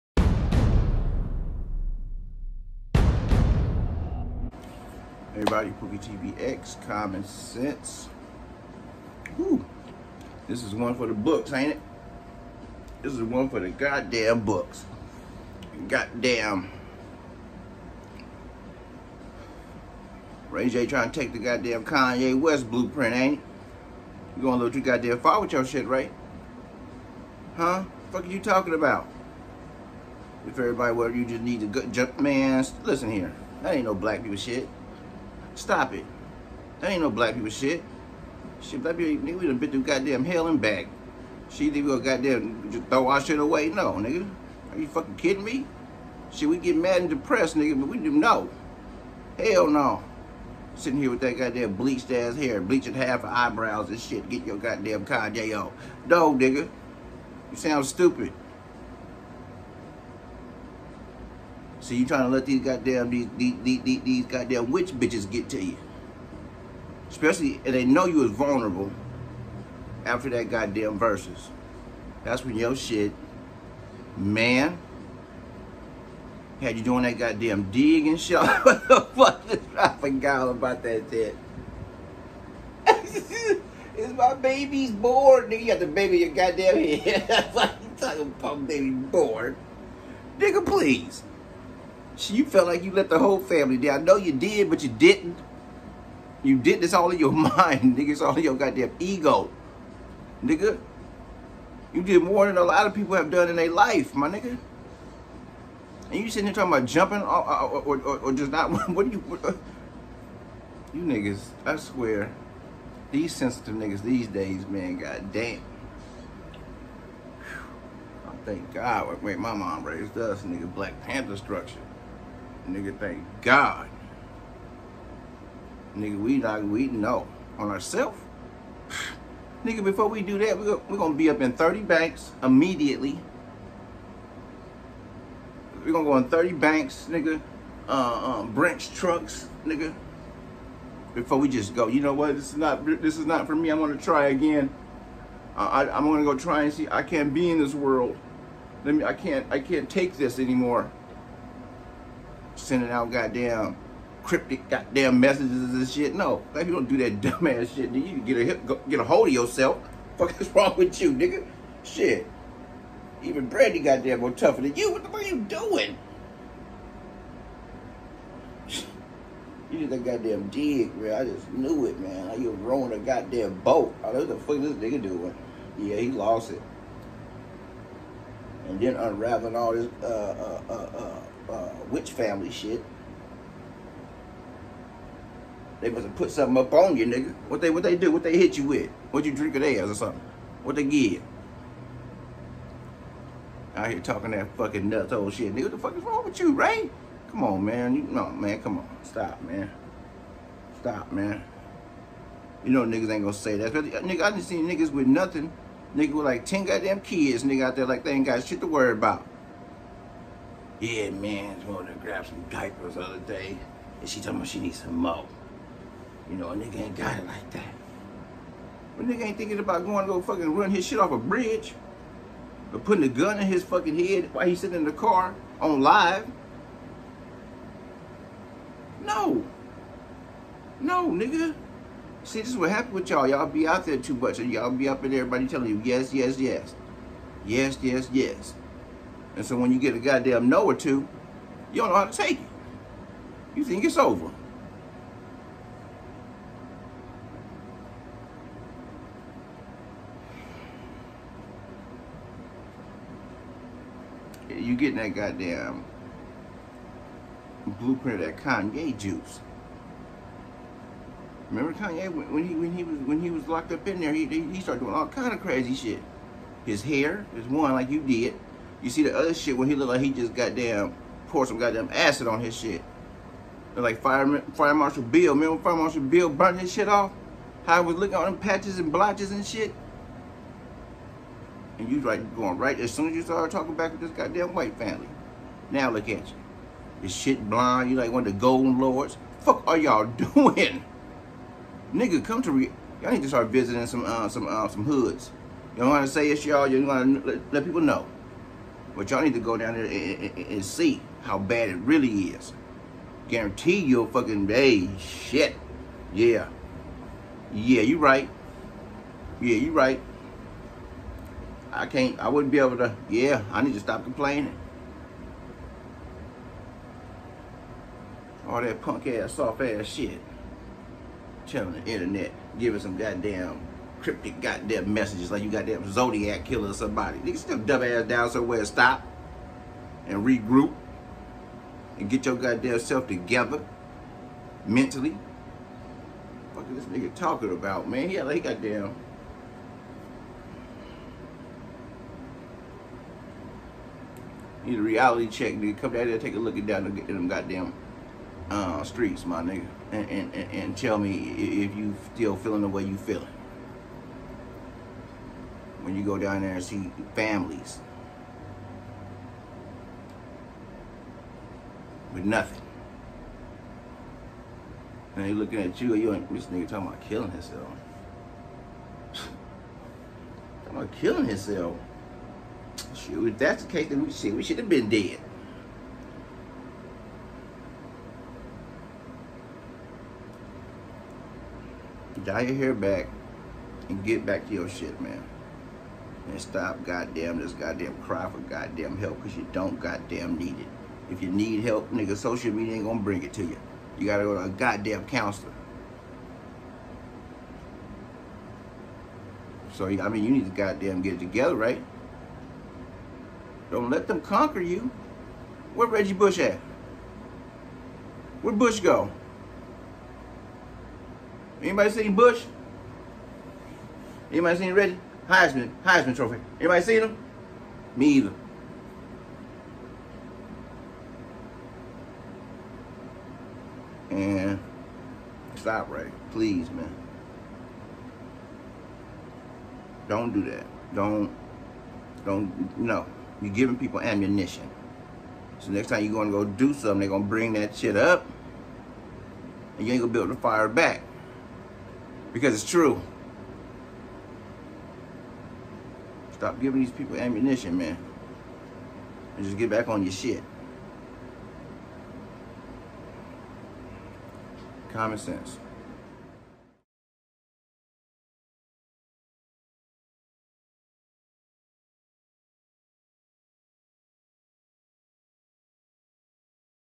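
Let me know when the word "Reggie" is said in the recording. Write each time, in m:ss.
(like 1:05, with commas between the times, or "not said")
6:45, 6:54.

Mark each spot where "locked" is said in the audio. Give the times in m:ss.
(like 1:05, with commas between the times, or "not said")
4:23.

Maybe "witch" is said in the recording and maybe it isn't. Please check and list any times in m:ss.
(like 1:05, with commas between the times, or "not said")
1:04, 3:01.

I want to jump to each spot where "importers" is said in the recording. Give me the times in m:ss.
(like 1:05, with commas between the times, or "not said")
not said.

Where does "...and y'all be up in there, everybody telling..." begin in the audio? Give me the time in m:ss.
3:54.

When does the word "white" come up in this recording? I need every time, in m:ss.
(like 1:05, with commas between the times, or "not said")
4:44.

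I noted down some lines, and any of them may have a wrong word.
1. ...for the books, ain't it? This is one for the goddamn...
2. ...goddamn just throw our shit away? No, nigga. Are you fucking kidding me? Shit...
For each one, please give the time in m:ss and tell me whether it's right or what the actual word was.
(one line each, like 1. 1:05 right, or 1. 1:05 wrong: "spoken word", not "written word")
1. 0:10 right
2. 0:42 right.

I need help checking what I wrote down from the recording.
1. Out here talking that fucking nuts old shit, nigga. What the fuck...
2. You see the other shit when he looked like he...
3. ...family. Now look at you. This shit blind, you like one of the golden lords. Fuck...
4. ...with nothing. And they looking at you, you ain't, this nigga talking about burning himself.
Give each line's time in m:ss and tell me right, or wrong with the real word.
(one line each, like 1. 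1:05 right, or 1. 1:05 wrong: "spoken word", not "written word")
1. 3:13 right
2. 4:28 right
3. 4:44 right
4. 6:02 wrong: "killing", not "burning".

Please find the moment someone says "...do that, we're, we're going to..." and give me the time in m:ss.
2:10.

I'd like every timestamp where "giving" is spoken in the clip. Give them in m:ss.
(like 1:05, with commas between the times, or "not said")
5:22, 7:13, 7:26.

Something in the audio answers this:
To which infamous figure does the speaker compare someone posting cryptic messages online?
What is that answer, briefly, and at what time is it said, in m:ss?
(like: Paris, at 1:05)
Zodiac killer, at 5:25.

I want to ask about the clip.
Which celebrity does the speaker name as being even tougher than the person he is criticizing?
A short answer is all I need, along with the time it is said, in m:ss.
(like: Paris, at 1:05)
Brandy, at 2:43.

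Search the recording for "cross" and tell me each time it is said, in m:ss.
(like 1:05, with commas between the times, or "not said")
not said.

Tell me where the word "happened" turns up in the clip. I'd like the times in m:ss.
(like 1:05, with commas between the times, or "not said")
3:52.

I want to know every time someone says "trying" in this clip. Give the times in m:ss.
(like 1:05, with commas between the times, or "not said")
0:20, 1:02.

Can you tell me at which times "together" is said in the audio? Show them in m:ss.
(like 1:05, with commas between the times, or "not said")
5:33, 6:41.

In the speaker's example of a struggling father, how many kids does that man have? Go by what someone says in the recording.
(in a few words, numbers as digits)
10.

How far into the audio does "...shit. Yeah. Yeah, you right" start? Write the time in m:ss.
5:04.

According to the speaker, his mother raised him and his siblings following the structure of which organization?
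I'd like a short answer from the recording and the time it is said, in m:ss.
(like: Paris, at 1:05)
Black Panther, at 2:00.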